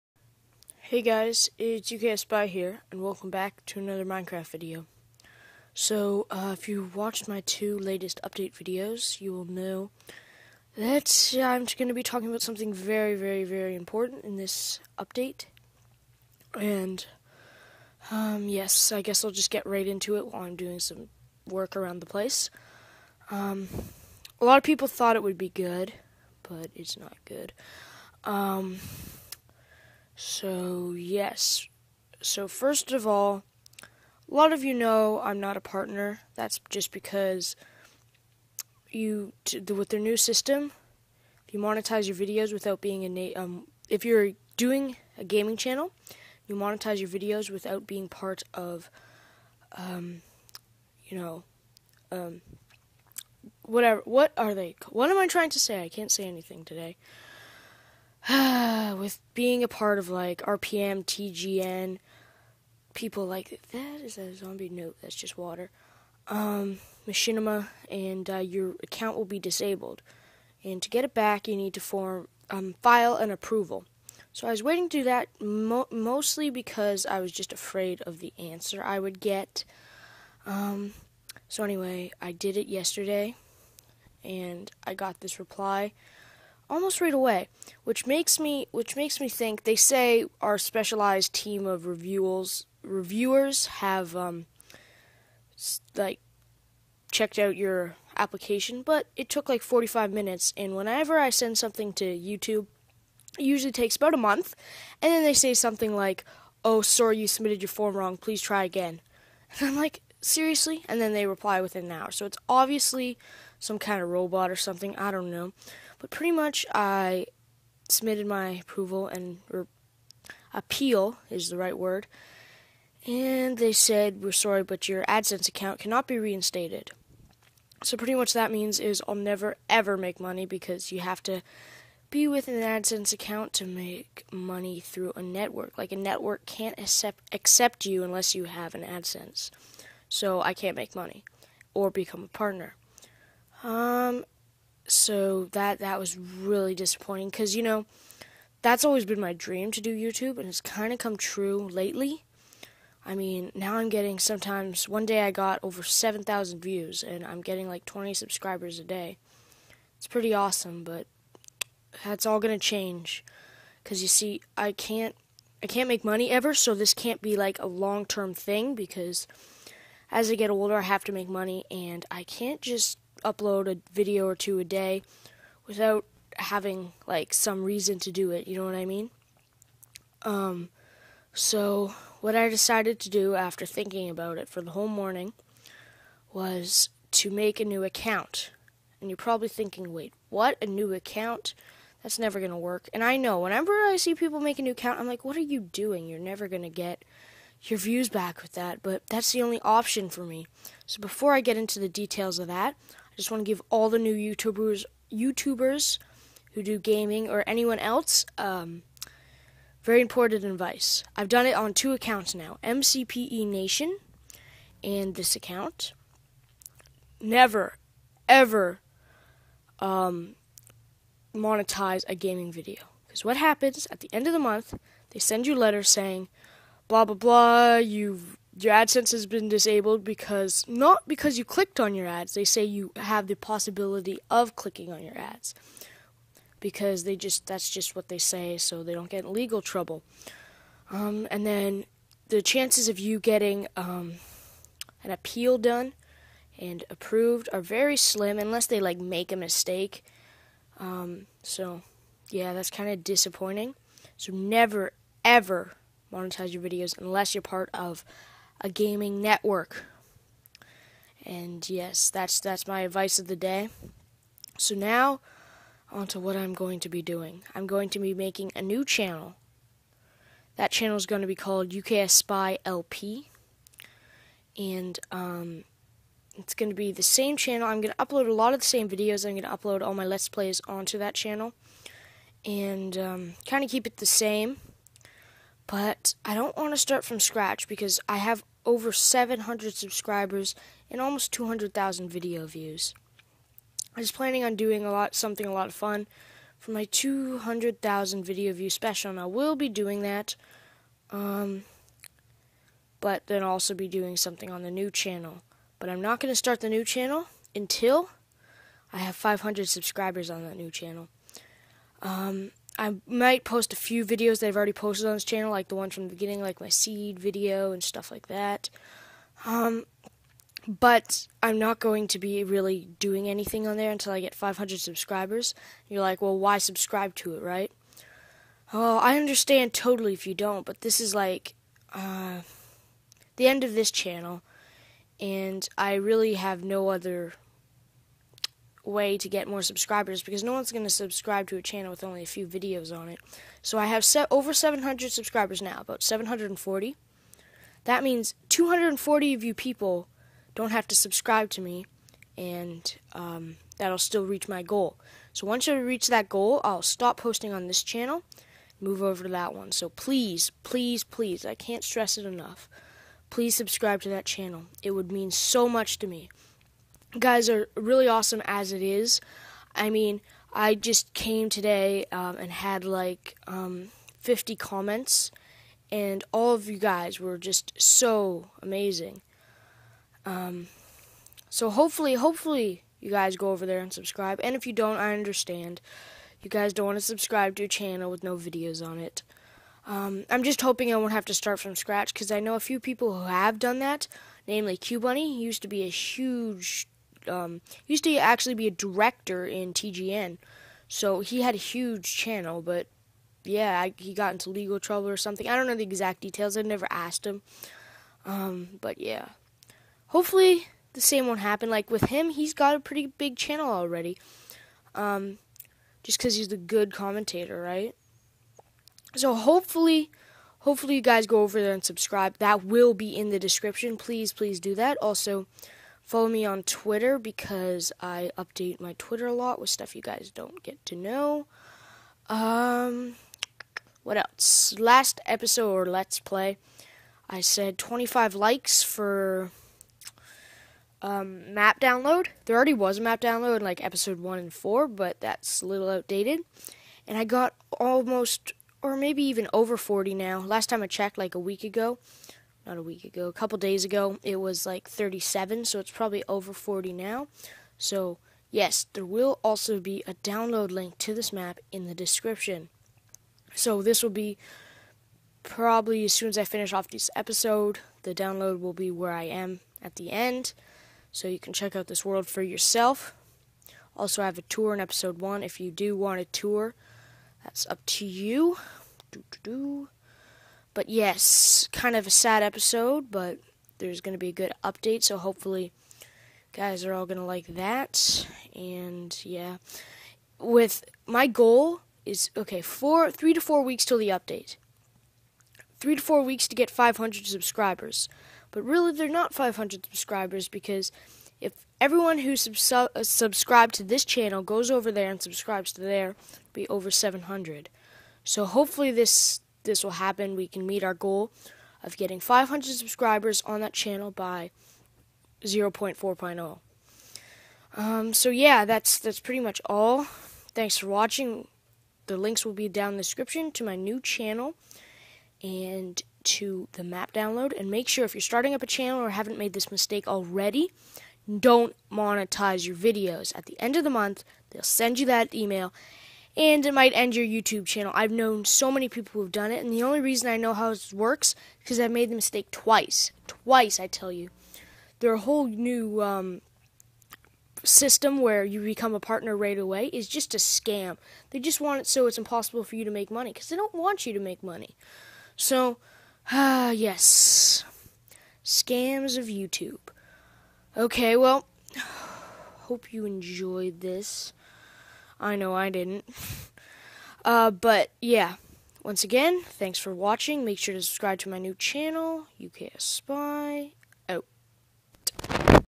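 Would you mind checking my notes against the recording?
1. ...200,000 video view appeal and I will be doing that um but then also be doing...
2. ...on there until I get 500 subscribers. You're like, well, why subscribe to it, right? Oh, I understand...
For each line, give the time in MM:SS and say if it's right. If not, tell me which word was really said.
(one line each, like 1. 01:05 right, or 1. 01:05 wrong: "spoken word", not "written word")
1. 04:56 wrong: "special", not "appeal"
2. 05:23 right.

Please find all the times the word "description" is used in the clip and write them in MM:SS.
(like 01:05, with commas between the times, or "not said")
07:03, 07:41, 08:43.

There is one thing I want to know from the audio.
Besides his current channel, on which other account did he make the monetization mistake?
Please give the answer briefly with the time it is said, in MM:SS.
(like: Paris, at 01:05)
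MCPE Nation, at 03:32.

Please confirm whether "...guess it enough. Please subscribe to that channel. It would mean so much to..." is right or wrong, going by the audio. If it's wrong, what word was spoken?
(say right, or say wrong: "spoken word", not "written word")
wrong: "stress", not "guess".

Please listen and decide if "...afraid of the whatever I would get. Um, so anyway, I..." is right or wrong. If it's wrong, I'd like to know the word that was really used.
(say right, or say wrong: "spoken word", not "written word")
wrong: "answer", not "whatever".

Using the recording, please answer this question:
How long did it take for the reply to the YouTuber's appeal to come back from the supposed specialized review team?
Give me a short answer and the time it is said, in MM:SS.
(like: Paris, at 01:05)
45 minutes, at 01:39.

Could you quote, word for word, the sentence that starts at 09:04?
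Their whole new um, system where you become a partner right away is just a scam.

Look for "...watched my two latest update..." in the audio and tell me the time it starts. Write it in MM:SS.
00:06.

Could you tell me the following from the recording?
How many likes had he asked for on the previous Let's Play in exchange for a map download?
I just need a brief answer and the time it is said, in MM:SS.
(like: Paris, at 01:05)
25, at 07:17.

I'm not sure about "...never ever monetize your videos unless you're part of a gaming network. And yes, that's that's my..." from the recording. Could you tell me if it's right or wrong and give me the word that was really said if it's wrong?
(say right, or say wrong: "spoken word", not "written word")
right.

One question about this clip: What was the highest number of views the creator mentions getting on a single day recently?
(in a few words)
7,000.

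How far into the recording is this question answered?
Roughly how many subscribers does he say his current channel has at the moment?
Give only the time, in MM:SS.
05:45.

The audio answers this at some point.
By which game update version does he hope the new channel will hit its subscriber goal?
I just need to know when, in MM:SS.
08:35.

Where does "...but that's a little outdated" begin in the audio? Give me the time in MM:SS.
07:24.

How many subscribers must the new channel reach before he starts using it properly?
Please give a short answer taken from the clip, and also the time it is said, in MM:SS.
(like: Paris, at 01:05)
500, at 05:09.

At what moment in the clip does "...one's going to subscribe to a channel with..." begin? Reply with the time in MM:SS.
05:40.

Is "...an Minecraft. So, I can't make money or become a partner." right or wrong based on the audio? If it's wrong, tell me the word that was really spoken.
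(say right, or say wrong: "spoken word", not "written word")
wrong: "AdSense", not "Minecraft".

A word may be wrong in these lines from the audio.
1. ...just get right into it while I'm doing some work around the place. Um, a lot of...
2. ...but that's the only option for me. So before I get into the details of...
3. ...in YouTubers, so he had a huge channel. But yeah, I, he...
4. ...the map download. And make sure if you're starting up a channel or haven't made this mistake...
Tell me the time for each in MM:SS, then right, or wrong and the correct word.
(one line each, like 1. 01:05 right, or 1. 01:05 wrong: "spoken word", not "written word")
1. 00:19 right
2. 03:18 right
3. 06:39 wrong: "TGN", not "YouTubers"
4. 08:46 right.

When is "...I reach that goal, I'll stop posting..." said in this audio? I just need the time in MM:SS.
05:55.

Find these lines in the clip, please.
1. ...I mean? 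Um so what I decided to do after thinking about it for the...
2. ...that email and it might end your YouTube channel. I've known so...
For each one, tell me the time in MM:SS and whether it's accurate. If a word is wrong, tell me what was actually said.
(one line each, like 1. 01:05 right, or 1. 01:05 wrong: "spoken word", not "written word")
1. 02:58 right
2. 08:55 right.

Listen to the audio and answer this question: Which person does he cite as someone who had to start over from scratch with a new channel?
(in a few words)
Qbunny.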